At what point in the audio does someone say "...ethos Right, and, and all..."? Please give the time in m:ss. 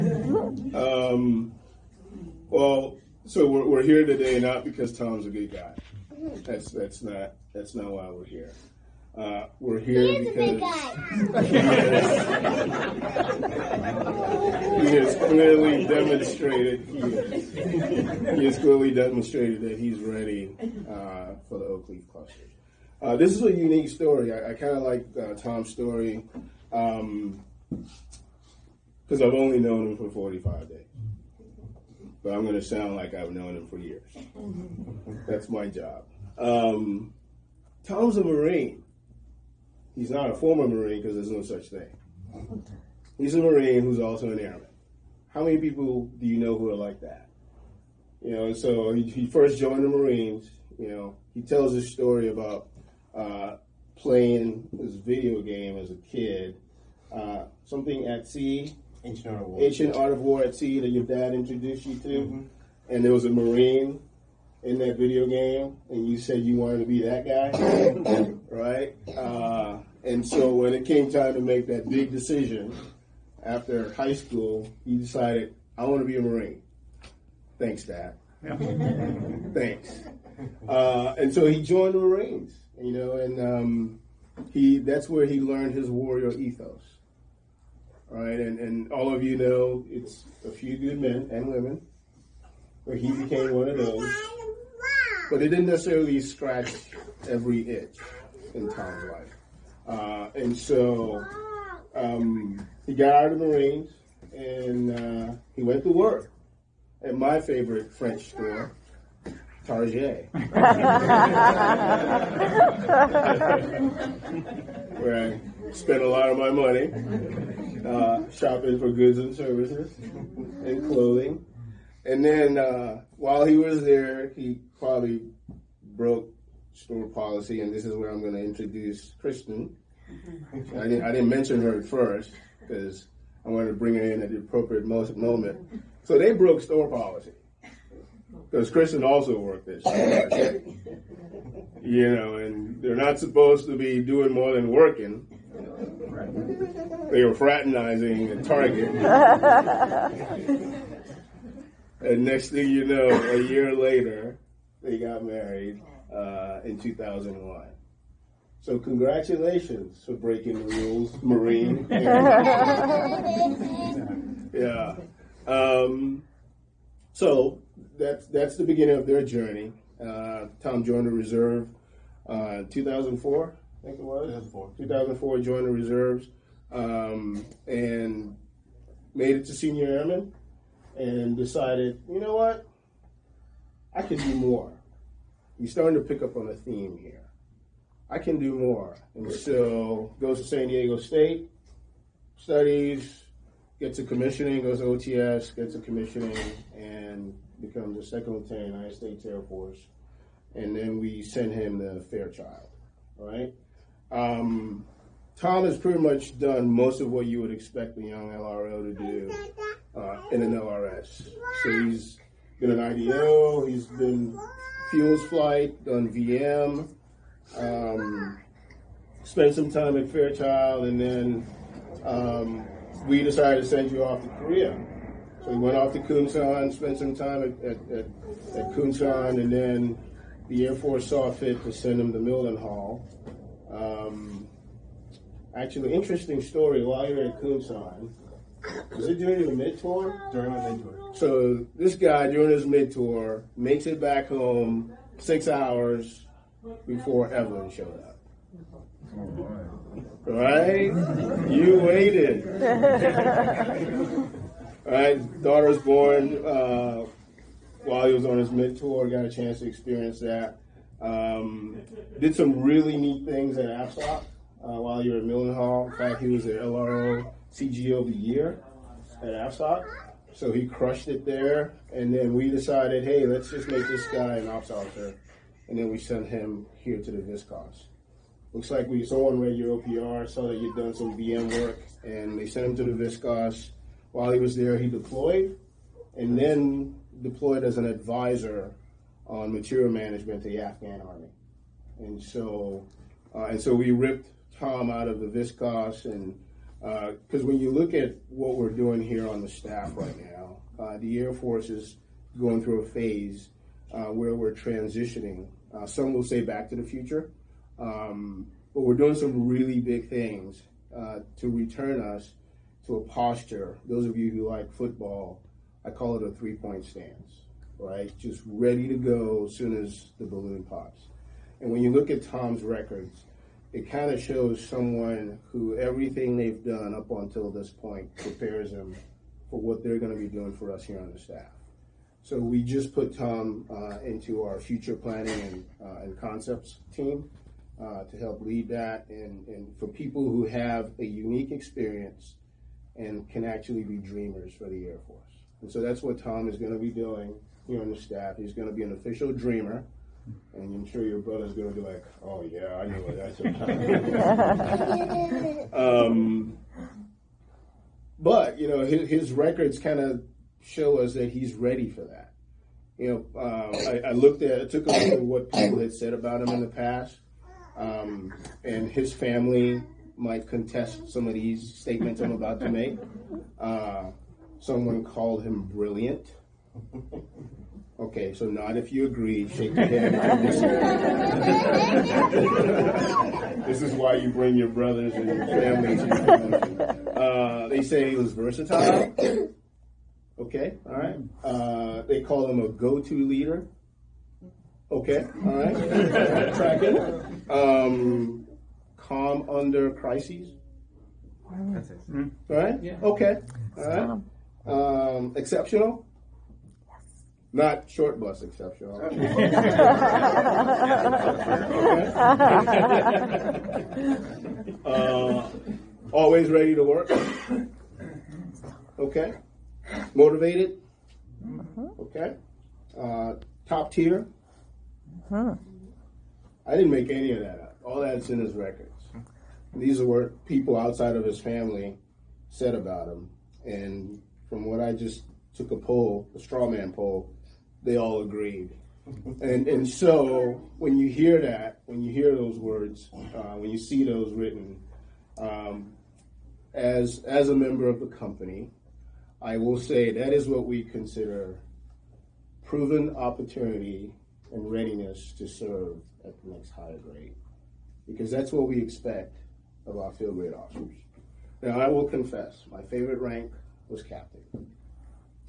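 1:26.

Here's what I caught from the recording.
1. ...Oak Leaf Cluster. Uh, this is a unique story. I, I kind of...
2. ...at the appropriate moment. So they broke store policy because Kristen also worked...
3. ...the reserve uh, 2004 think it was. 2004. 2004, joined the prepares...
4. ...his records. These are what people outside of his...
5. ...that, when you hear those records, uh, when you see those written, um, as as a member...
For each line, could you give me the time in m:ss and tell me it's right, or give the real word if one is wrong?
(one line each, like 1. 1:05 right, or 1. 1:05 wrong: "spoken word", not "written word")
1. 0:21 right
2. 2:14 right
3. 2:51 wrong: "reserves", not "prepares"
4. 7:08 right
5. 7:21 wrong: "words", not "records".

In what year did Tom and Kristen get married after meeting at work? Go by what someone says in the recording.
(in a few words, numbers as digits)
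2001.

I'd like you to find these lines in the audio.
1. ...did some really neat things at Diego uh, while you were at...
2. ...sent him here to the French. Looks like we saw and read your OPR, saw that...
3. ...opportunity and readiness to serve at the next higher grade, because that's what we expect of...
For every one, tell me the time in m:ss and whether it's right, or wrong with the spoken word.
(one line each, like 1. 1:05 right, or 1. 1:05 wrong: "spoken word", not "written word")
1. 4:22 wrong: "AppStop", not "Diego"
2. 4:35 wrong: "VisCos", not "French"
3. 7:33 right.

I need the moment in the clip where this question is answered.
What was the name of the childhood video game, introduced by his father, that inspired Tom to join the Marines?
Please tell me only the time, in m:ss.
0:59.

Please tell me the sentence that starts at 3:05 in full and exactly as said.
You're starting to pick up on a theme here.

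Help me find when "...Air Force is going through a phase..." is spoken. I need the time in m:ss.
5:01.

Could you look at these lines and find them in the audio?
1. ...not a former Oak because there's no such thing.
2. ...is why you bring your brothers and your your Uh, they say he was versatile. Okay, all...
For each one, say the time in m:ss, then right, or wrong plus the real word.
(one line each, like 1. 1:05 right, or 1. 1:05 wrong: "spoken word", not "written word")
1. 0:40 wrong: "Marine", not "Oak"
2. 6:23 right.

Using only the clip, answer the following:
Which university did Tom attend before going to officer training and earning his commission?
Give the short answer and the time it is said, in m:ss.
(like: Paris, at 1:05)
San Diego State, at 3:10.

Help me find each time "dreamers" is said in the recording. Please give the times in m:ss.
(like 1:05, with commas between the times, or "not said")
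5:43, 5:49.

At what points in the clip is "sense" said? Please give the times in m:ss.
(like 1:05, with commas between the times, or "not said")
not said.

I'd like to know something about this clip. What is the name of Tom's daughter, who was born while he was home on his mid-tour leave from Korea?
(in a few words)
Evelyn.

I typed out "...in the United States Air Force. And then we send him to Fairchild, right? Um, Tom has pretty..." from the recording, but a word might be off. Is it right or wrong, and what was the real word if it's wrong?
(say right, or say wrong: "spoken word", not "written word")
right.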